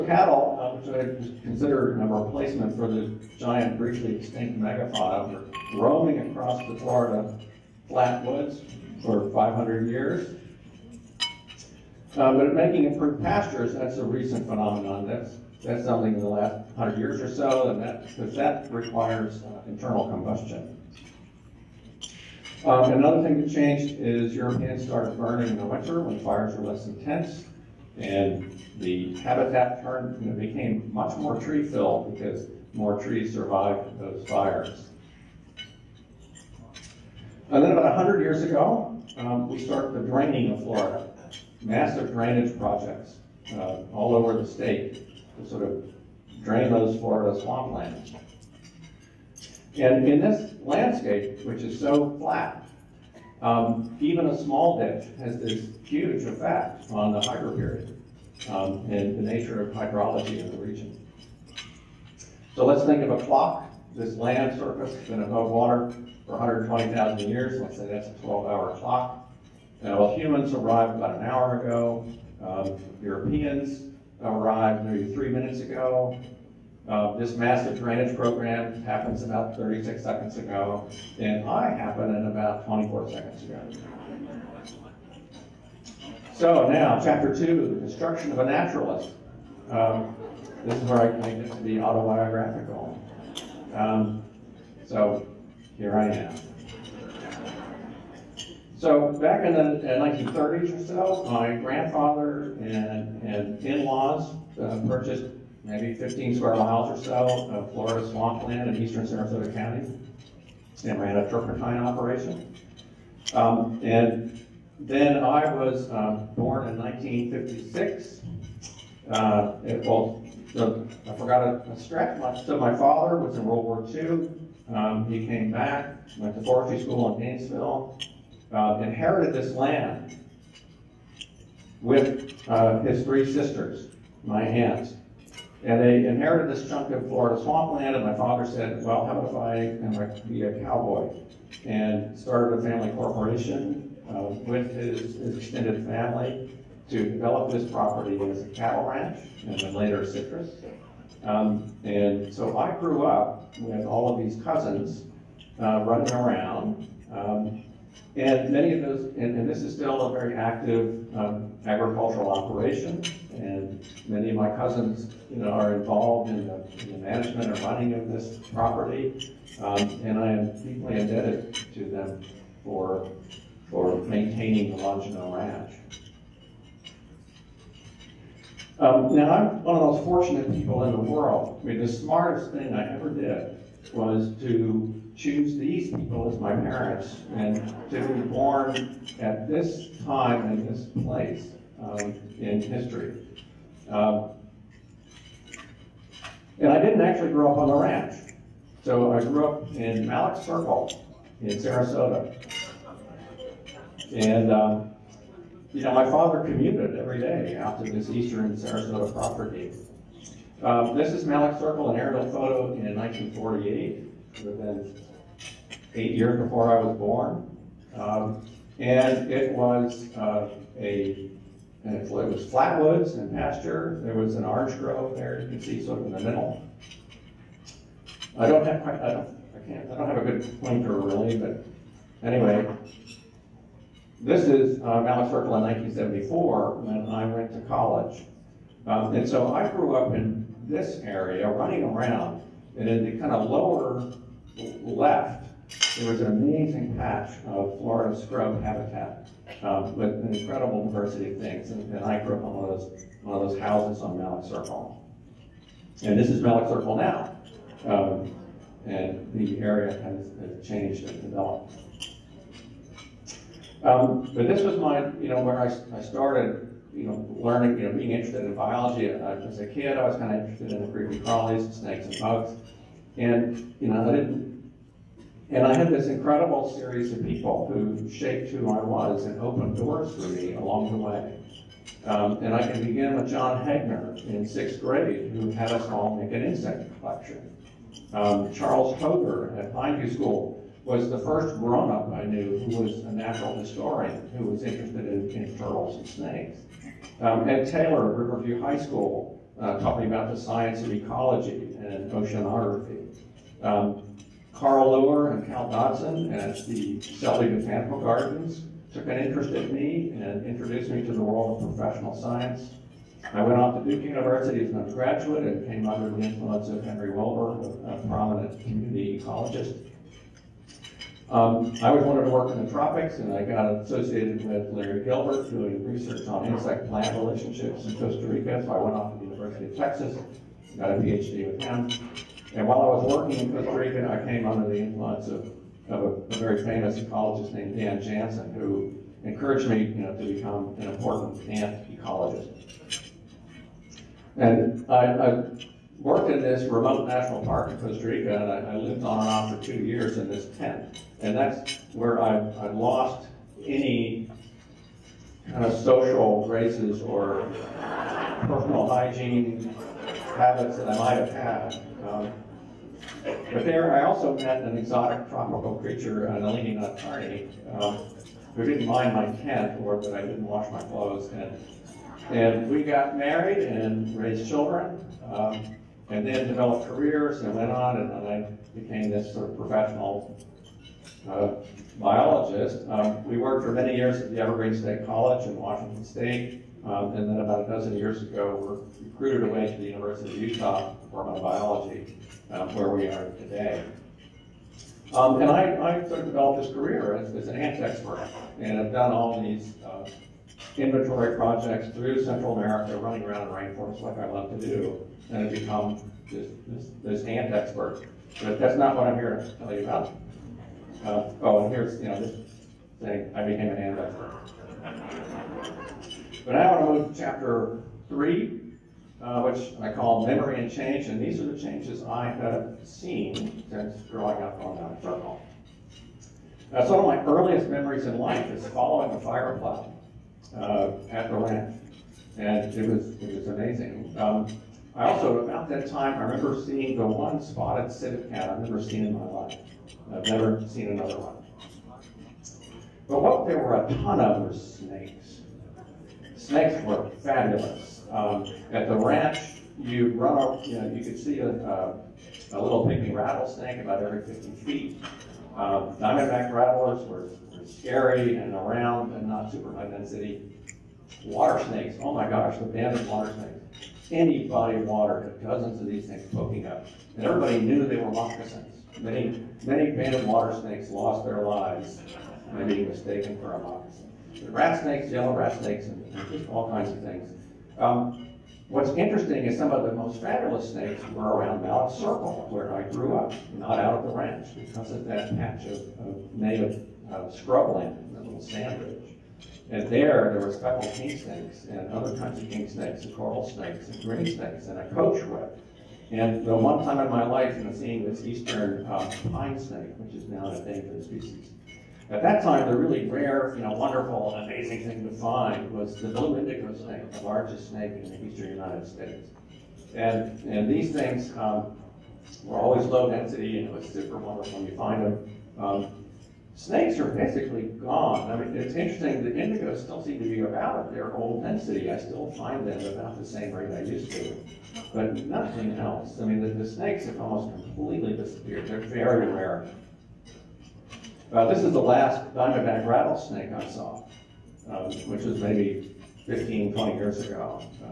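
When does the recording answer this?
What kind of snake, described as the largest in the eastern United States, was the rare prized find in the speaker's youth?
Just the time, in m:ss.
8:26.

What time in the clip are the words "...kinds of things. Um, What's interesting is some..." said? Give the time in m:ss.
7:56.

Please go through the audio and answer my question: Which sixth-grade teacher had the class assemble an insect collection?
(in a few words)
John Hagner.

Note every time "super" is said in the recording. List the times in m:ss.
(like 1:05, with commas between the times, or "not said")
7:39, 8:33.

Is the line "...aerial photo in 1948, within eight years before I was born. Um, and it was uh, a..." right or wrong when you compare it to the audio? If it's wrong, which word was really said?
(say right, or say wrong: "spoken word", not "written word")
right.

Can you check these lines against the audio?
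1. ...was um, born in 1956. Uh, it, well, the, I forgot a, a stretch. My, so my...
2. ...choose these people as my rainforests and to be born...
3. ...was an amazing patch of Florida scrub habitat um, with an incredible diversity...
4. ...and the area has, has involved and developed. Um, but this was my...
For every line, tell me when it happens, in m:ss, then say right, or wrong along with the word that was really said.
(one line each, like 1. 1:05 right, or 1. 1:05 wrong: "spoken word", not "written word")
1. 1:55 right
2. 3:05 wrong: "parents", not "rainforests"
3. 4:06 right
4. 4:18 wrong: "changed", not "involved".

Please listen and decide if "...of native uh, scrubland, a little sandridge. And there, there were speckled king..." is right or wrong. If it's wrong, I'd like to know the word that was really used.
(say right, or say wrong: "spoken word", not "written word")
right.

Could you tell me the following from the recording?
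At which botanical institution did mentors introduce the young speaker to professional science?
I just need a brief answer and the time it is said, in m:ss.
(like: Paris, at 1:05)
Selby Botanical Gardens, at 5:07.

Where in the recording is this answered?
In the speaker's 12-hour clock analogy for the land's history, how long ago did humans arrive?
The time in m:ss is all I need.
1:10.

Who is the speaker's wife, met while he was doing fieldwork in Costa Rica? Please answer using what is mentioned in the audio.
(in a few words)
Nalini Nadkarni.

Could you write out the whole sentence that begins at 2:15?
And they inherited this chunk of Florida swampland, and my father said, well, how about if I am be a cowboy?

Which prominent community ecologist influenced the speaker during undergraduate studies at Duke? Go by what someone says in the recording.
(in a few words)
Henry Wilbur.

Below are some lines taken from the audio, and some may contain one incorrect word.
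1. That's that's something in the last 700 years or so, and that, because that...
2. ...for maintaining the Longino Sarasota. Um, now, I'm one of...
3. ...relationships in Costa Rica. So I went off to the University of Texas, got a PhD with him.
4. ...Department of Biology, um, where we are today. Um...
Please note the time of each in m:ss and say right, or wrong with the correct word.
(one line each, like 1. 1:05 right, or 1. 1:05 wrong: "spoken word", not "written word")
1. 0:15 wrong: "100", not "700"
2. 2:53 wrong: "Ranch", not "Sarasota"
3. 5:27 right
4. 6:30 right.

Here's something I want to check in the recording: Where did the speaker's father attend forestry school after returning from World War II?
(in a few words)
Gainesville.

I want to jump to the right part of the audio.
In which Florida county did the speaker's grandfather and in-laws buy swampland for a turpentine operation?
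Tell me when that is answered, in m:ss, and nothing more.
1:48.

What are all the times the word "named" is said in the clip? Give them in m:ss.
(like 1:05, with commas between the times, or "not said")
5:37.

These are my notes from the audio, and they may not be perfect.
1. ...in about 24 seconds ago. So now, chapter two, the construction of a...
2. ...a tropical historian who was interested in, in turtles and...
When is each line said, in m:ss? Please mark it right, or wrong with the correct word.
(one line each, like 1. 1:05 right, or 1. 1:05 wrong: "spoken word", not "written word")
1. 1:22 right
2. 4:53 wrong: "natural", not "tropical".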